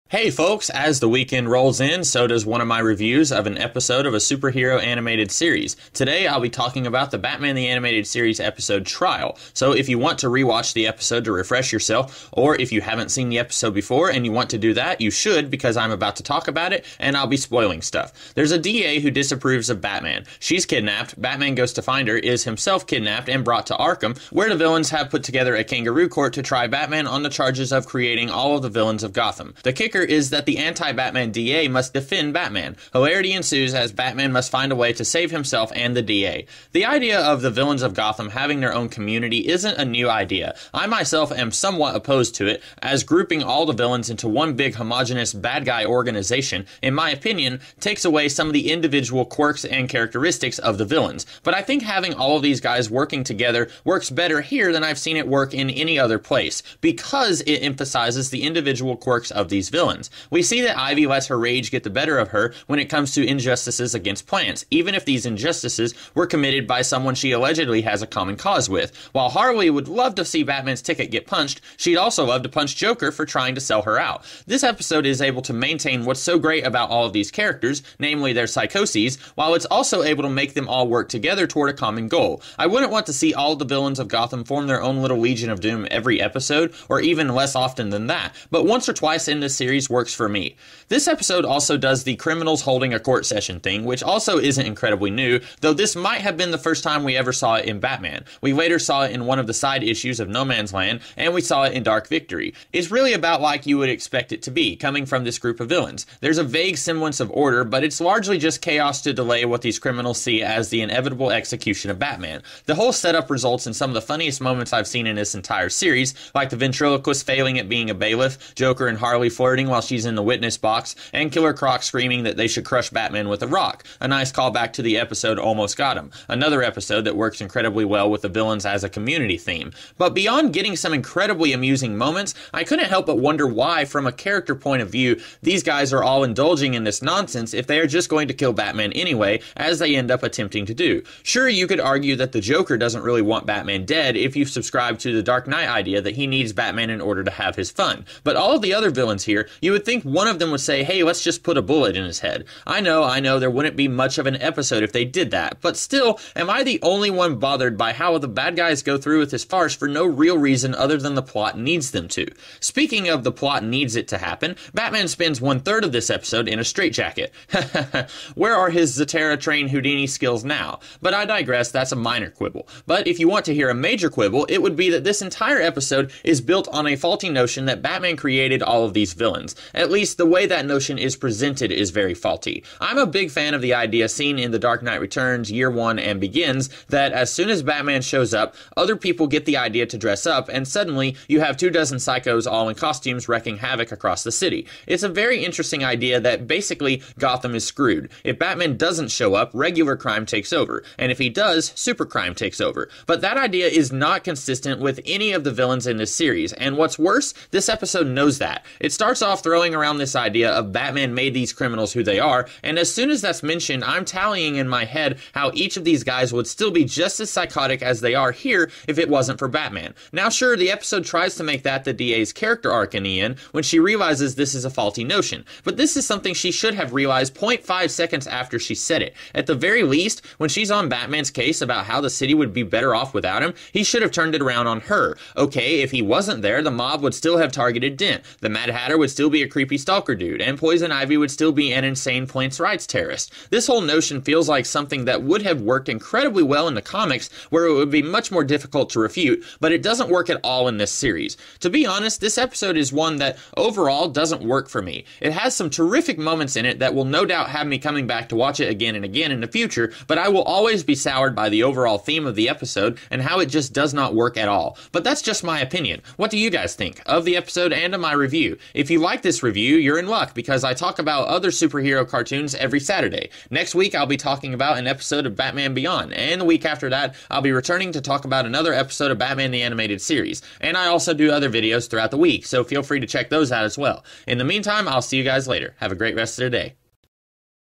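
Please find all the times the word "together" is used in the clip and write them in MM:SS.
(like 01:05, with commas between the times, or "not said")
00:25, 00:53, 01:21.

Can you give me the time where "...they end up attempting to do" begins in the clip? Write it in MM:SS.
02:19.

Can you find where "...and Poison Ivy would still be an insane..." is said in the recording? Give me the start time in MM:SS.
04:00.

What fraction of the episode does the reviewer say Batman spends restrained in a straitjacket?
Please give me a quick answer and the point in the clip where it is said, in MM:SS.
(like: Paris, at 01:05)
One third, at 02:45.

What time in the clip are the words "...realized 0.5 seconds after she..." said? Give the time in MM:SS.
03:46.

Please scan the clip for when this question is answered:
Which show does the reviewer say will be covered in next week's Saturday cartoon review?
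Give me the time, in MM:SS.
04:35.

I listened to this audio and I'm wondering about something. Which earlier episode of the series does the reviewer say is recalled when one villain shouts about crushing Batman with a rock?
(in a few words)
Almost Got Him.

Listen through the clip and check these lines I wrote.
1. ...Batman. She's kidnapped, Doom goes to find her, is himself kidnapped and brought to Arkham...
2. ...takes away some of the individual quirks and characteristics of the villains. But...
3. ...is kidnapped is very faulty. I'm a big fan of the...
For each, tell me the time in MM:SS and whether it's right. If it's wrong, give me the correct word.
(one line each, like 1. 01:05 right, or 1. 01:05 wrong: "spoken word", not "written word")
1. 00:19 wrong: "Batman", not "Doom"
2. 00:47 right
3. 03:00 wrong: "presented", not "kidnapped".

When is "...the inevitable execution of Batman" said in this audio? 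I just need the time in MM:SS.
01:50.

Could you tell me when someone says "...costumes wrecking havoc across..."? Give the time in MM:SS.
03:12.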